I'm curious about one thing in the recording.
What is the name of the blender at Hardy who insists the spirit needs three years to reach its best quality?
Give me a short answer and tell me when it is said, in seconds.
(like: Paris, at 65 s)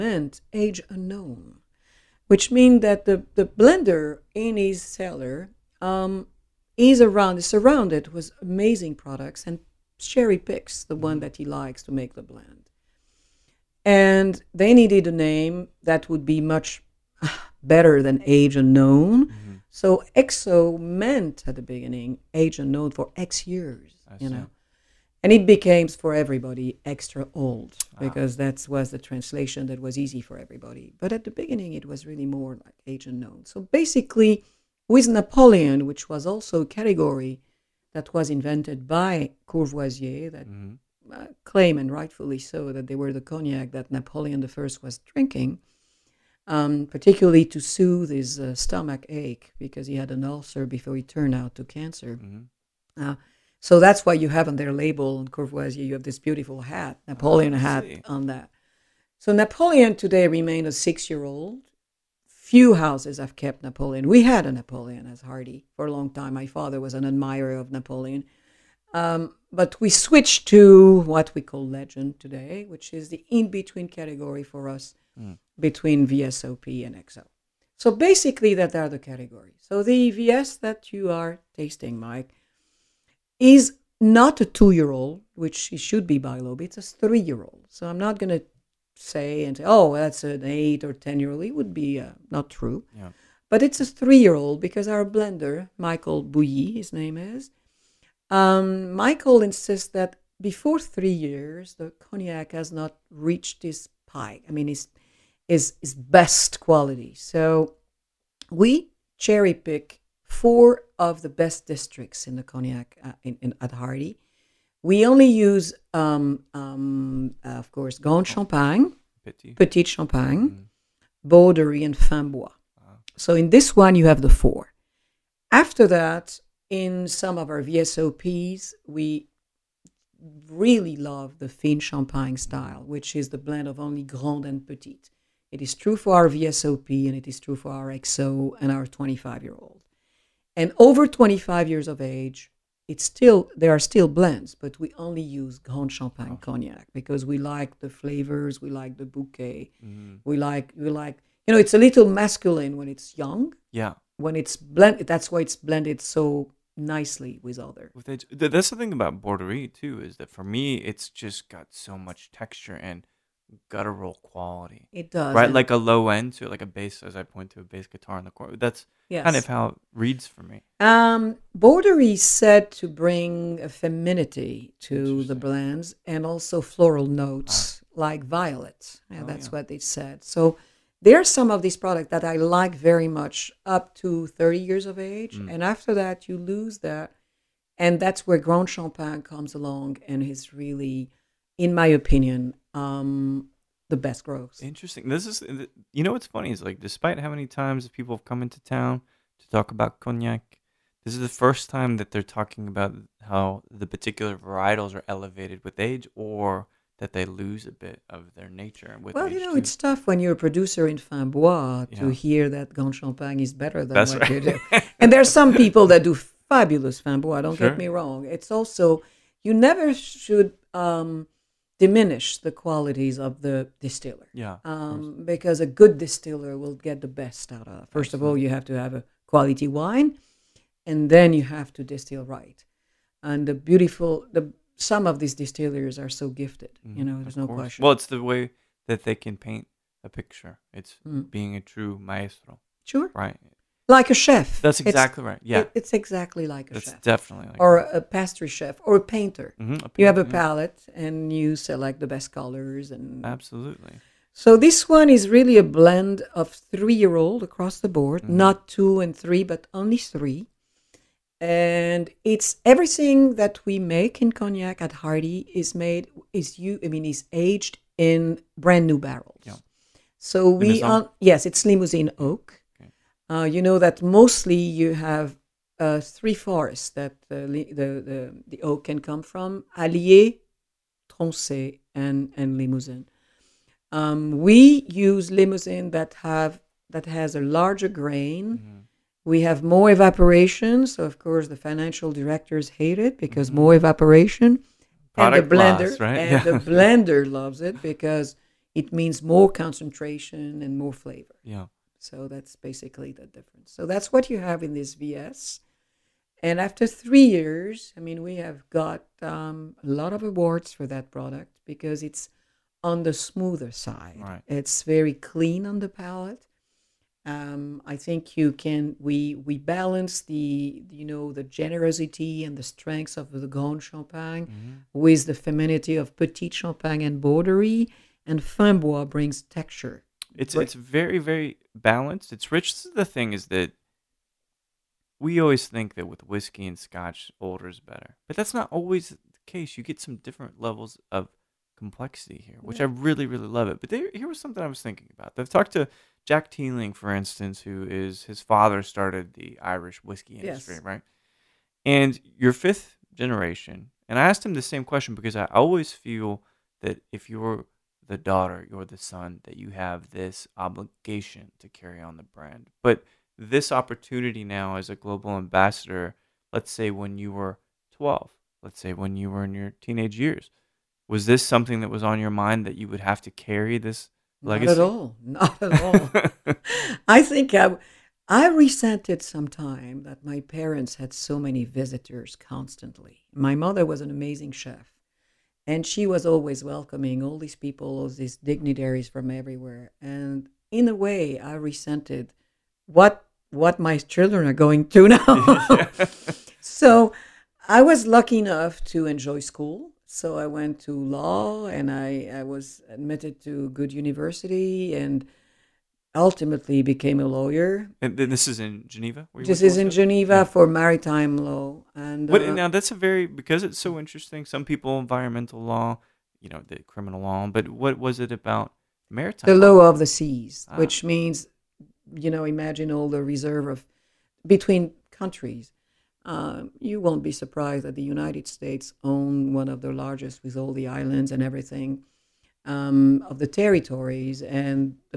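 Michael Bouilly, at 95 s.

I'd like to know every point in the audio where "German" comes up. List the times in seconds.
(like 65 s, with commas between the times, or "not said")
not said.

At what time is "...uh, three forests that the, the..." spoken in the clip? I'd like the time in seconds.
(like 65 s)
275 s.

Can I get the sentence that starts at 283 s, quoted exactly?
Um, we use Limousin that, have, that has a larger grain.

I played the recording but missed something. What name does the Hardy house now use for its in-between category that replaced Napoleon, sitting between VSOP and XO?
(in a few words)
Legend.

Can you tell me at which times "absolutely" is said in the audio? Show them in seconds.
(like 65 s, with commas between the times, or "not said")
228 s, 253 s.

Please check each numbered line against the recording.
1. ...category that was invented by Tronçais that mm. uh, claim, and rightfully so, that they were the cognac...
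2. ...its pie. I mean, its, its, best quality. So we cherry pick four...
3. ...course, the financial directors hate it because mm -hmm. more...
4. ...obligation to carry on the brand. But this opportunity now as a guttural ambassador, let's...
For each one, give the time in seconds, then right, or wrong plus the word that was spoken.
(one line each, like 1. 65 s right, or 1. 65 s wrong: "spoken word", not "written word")
1. 36 s wrong: "Courvoisier", not "Tronçais"
2. 103 s right
3. 291 s right
4. 360 s wrong: "global", not "guttural".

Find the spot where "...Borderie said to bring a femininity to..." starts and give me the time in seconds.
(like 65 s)
171 s.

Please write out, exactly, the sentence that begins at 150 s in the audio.
we like we like you know it's a little masculine when it's young.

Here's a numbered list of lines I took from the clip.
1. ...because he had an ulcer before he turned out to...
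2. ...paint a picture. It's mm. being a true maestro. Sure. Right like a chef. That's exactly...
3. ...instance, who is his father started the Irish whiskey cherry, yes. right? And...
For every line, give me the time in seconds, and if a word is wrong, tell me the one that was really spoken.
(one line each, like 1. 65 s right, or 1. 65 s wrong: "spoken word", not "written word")
1. 49 s right
2. 239 s right
3. 347 s wrong: "industry", not "cherry".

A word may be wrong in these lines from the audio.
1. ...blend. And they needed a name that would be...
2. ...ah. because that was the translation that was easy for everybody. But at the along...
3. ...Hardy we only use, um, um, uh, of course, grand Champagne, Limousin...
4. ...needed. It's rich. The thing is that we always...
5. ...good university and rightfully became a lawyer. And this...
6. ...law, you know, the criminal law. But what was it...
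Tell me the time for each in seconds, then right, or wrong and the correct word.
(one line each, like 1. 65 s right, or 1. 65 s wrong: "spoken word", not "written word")
1. 12 s right
2. 27 s wrong: "beginning", not "along"
3. 113 s wrong: "Petit", not "Limousin"
4. 331 s wrong: "balanced", not "needed"
5. 403 s wrong: "ultimately", not "rightfully"
6. 415 s right.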